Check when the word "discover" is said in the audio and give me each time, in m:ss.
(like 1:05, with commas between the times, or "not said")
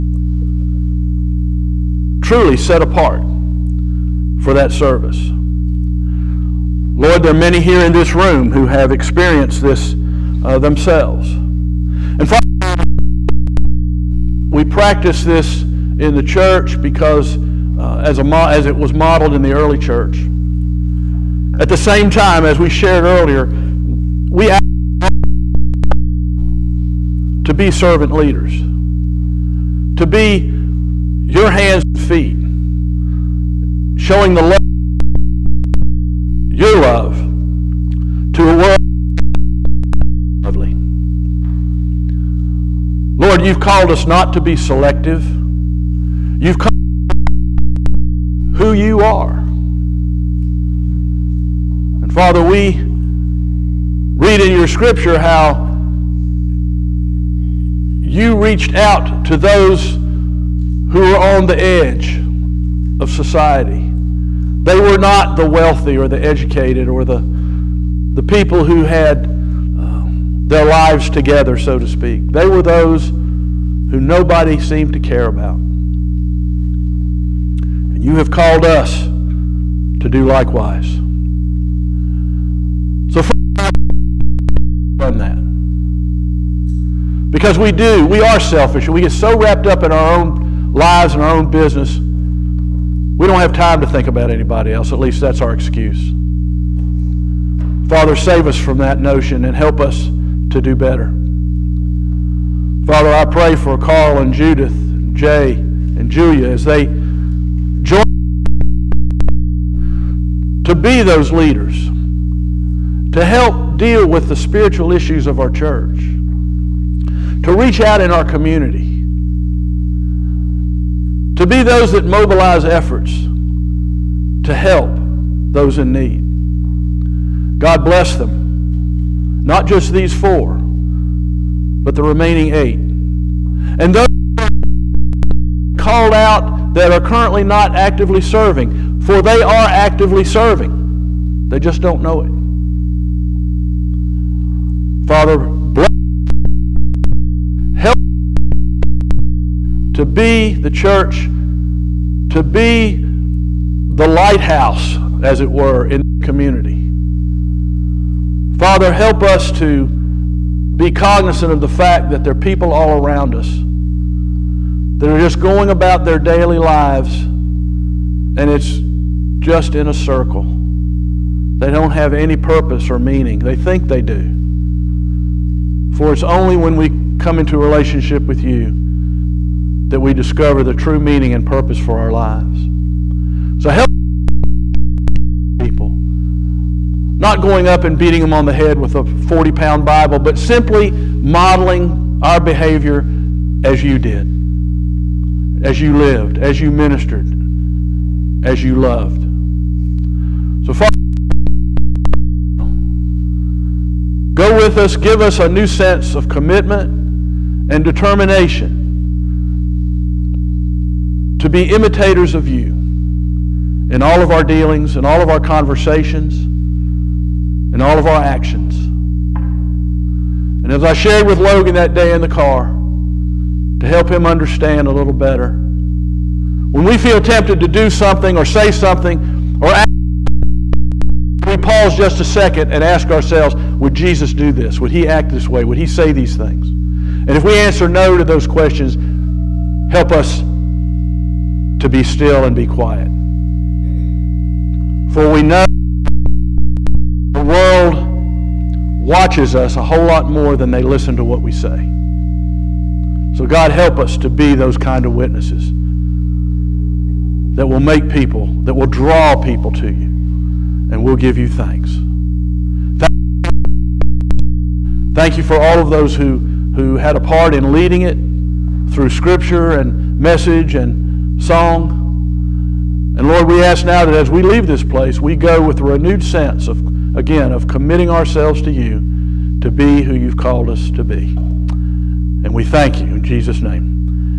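3:00.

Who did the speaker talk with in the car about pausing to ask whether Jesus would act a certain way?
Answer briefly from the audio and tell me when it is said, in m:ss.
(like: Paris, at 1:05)
Logan, at 3:41.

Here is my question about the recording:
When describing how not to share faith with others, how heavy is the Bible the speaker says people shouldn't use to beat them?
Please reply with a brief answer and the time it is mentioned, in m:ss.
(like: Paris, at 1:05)
40 pounds, at 3:09.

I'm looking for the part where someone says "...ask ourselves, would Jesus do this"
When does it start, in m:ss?
3:52.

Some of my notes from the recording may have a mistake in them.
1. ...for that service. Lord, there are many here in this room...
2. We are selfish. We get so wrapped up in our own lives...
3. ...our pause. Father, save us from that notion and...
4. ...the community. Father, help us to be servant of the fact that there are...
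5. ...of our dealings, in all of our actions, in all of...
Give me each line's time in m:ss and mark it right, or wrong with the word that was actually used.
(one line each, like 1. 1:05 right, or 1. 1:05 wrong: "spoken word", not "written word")
1. 0:04 right
2. 1:28 right
3. 1:35 wrong: "excuse", not "pause"
4. 2:36 wrong: "cognizant", not "servant"
5. 3:34 wrong: "conversations", not "actions".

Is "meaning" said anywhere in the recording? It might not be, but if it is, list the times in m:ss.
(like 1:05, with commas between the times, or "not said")
2:53, 3:00.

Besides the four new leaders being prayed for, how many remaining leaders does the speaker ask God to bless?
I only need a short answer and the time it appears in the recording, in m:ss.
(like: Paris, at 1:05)
8, at 2:12.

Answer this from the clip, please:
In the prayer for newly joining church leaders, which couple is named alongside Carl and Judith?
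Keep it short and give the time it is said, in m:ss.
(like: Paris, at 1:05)
Jay and Julia, at 1:45.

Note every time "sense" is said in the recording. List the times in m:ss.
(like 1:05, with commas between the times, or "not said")
3:25, 4:36.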